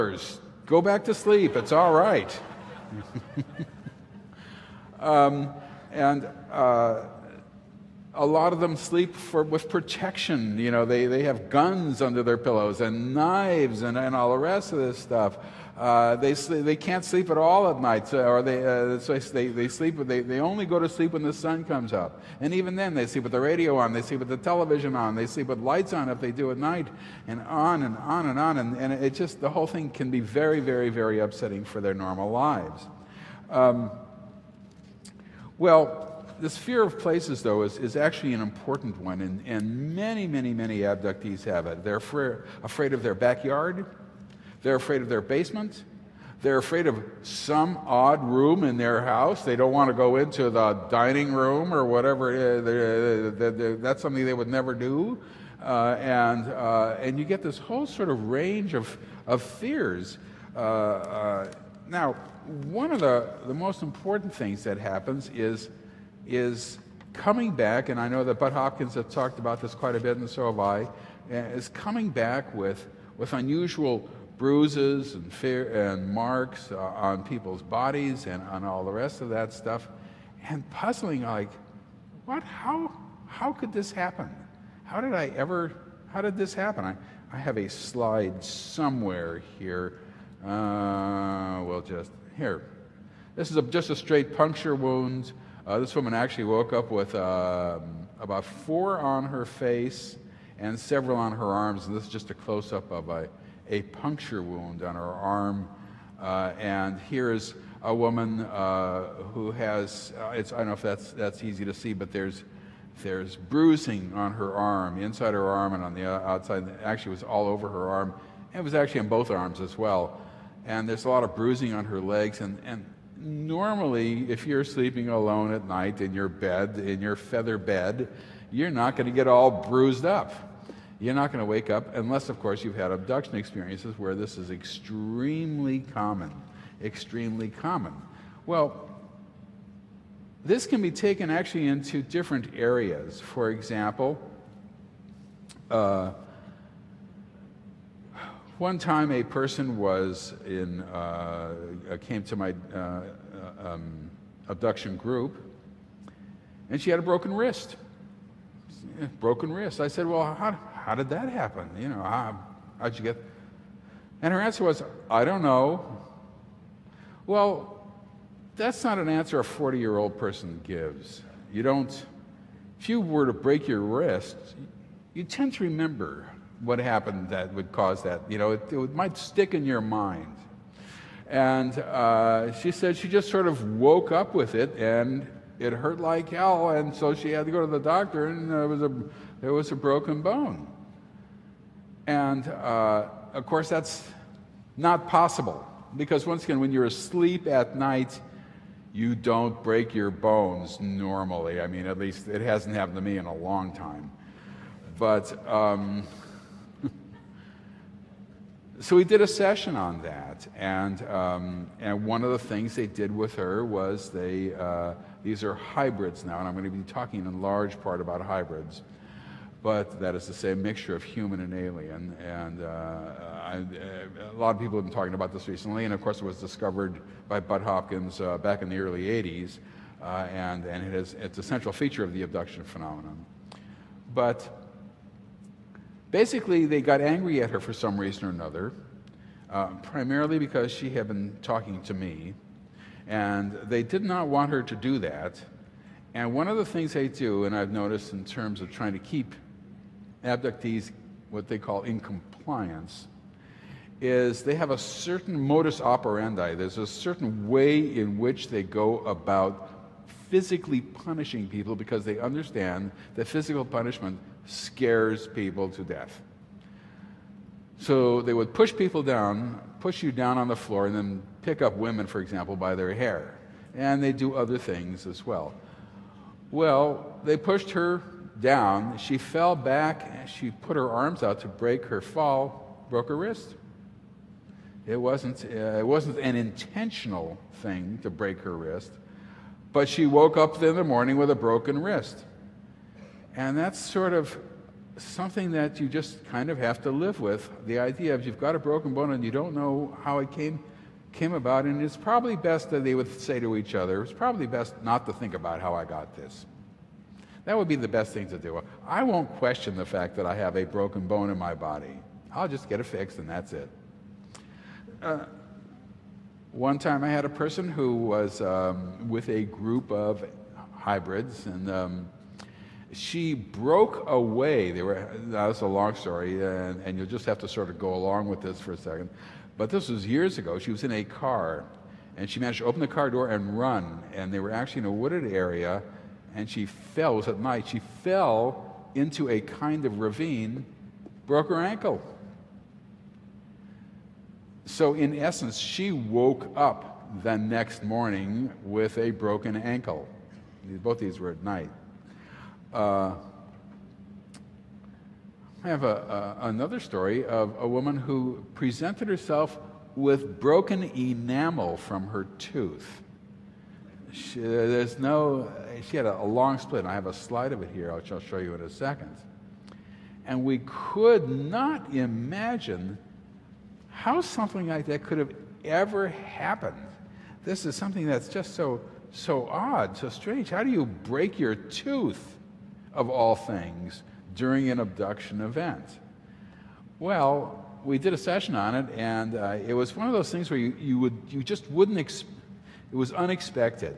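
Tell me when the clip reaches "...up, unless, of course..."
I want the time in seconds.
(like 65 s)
131 s.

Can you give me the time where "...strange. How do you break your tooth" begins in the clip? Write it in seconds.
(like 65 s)
380 s.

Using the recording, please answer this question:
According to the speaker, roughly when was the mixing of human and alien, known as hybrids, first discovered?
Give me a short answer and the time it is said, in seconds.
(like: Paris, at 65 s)
early 80s, at 228 s.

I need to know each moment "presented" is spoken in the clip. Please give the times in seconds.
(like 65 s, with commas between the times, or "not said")
358 s.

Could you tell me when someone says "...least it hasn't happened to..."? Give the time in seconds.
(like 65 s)
201 s.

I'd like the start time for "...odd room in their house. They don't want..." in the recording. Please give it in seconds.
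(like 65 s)
47 s.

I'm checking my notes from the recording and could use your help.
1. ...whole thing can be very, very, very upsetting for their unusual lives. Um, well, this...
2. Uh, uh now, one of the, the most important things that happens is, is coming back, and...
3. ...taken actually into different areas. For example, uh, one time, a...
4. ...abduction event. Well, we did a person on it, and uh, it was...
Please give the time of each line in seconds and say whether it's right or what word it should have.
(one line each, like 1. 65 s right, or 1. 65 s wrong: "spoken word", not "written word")
1. 29 s wrong: "normal", not "unusual"
2. 60 s right
3. 140 s right
4. 384 s wrong: "session", not "person".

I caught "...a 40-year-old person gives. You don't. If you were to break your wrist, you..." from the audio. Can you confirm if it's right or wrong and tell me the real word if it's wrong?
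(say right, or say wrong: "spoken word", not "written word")
right.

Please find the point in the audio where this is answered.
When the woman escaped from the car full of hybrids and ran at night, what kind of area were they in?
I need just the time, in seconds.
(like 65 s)
334 s.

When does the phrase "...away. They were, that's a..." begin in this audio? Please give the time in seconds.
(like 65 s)
324 s.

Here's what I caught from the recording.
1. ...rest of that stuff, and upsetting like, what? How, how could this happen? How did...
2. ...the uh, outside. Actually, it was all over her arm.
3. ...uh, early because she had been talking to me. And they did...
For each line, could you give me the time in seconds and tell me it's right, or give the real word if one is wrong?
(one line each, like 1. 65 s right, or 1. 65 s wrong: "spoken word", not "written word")
1. 78 s wrong: "puzzling", not "upsetting"
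2. 115 s right
3. 239 s wrong: "primarily", not "early".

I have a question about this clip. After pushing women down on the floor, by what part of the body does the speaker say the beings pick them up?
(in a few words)
their hair.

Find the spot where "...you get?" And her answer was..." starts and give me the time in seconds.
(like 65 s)
162 s.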